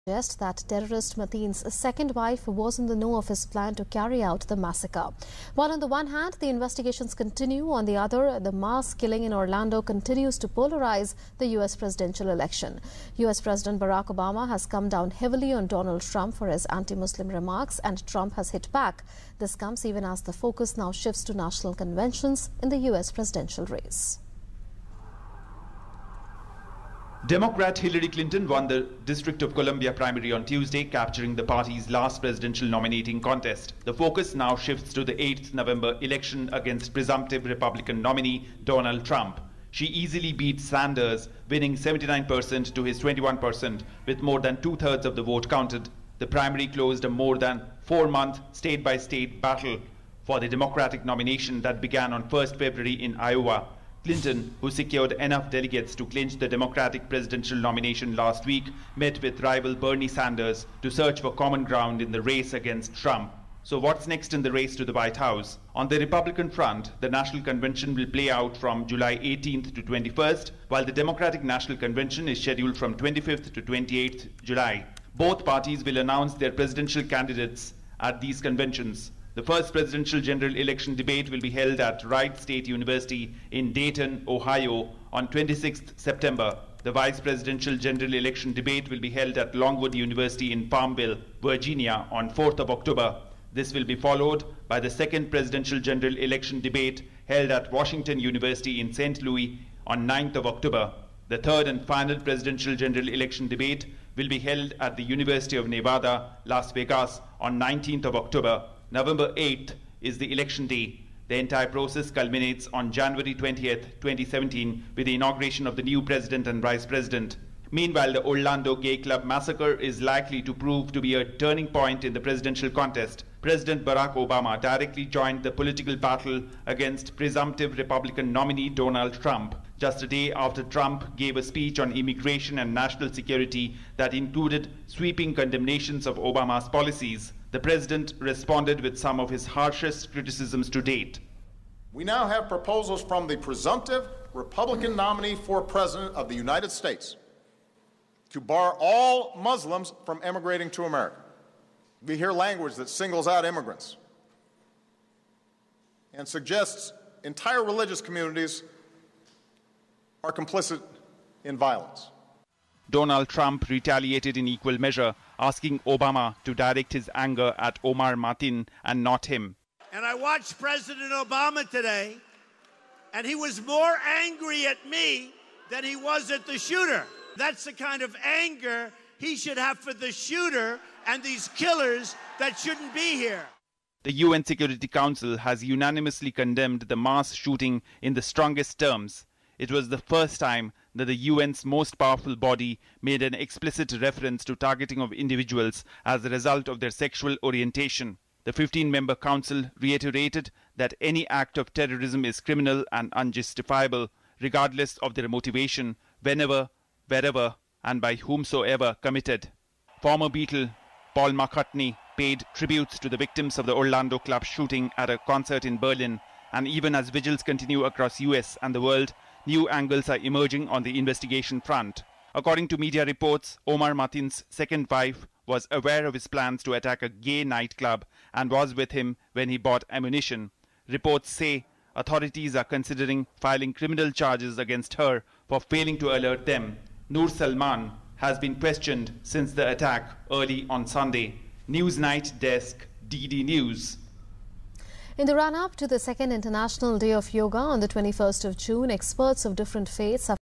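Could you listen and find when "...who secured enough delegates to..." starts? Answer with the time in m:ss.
0:54.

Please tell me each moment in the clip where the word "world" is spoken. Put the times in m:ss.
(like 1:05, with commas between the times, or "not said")
3:38.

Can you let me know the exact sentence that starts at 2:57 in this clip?
That's the kind of anger he should have for the shooter and these killers that shouldn't be here.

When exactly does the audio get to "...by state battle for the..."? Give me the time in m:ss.
0:48.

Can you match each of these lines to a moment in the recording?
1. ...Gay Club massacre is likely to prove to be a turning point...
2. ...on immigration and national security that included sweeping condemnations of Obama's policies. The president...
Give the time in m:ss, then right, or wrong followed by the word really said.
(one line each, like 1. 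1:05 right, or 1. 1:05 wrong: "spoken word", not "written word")
1. 1:58 right
2. 2:11 right.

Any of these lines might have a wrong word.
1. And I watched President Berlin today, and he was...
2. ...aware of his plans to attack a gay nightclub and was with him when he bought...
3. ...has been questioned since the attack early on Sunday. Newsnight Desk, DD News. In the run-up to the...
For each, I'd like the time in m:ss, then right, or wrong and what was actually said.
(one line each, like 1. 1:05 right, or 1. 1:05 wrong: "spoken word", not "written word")
1. 2:49 wrong: "Obama", not "Berlin"
2. 3:45 right
3. 3:58 right.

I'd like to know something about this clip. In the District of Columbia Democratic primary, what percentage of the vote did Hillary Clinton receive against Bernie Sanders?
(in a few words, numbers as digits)
79%.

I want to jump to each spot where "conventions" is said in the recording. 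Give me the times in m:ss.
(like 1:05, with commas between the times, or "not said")
0:21, 1:07, 1:11, 1:18.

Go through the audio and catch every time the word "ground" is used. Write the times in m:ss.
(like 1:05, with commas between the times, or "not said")
1:01.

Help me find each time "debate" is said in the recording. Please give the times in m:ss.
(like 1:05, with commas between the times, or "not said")
1:20, 1:28, 1:36, 1:43.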